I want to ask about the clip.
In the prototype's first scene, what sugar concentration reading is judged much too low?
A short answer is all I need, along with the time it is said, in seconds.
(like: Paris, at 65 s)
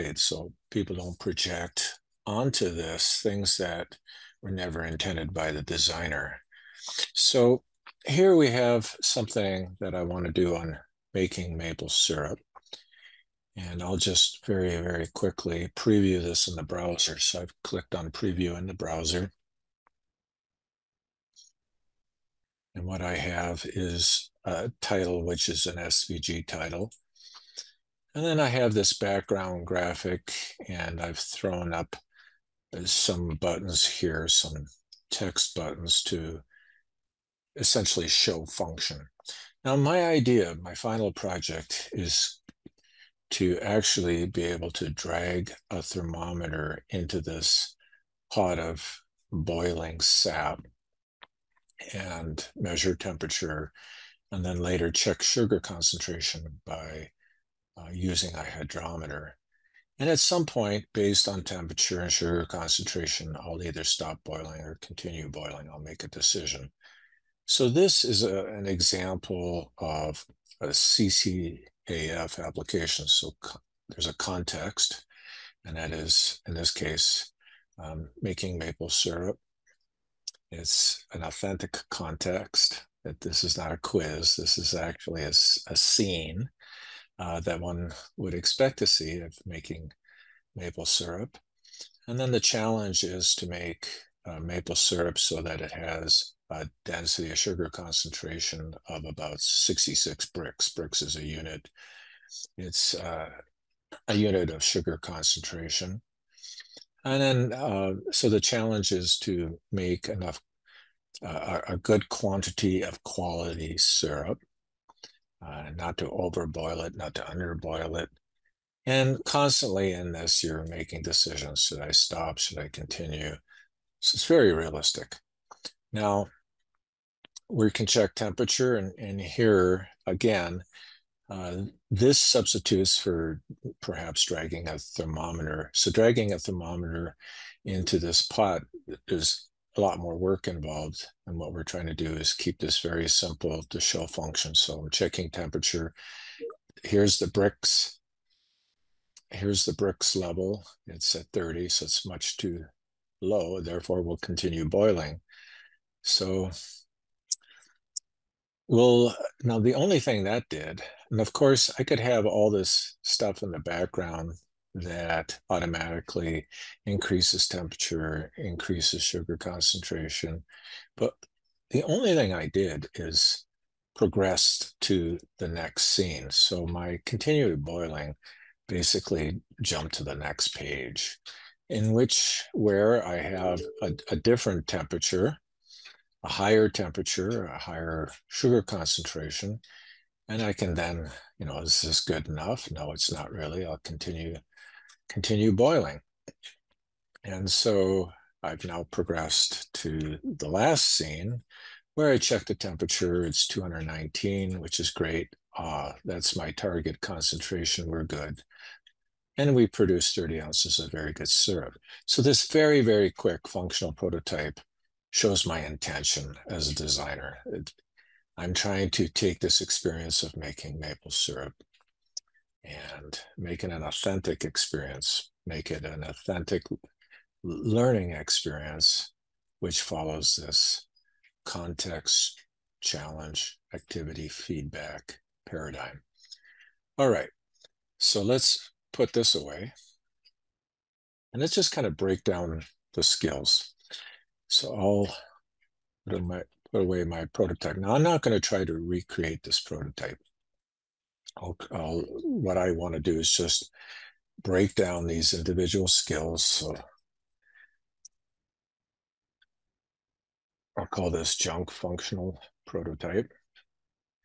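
30, at 150 s.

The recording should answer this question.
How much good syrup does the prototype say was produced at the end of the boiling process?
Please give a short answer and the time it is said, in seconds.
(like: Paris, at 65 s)
30 ounces, at 210 s.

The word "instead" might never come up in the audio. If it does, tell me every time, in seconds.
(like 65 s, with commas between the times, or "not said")
not said.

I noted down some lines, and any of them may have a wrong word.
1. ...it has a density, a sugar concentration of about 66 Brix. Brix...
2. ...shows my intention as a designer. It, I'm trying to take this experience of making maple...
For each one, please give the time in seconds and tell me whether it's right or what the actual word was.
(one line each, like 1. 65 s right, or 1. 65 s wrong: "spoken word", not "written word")
1. 95 s right
2. 215 s right.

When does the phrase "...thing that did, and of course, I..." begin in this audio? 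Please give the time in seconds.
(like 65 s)
160 s.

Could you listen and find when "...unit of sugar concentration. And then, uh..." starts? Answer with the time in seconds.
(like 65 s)
104 s.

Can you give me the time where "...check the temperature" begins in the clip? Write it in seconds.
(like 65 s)
202 s.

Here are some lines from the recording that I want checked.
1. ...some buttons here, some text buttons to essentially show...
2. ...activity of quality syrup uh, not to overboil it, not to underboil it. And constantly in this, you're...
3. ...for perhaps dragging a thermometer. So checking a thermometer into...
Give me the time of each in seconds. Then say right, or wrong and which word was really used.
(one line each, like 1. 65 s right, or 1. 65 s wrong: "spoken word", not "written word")
1. 32 s right
2. 112 s wrong: "quantity", not "activity"
3. 132 s wrong: "dragging", not "checking".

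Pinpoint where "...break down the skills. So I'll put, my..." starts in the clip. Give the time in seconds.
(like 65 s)
241 s.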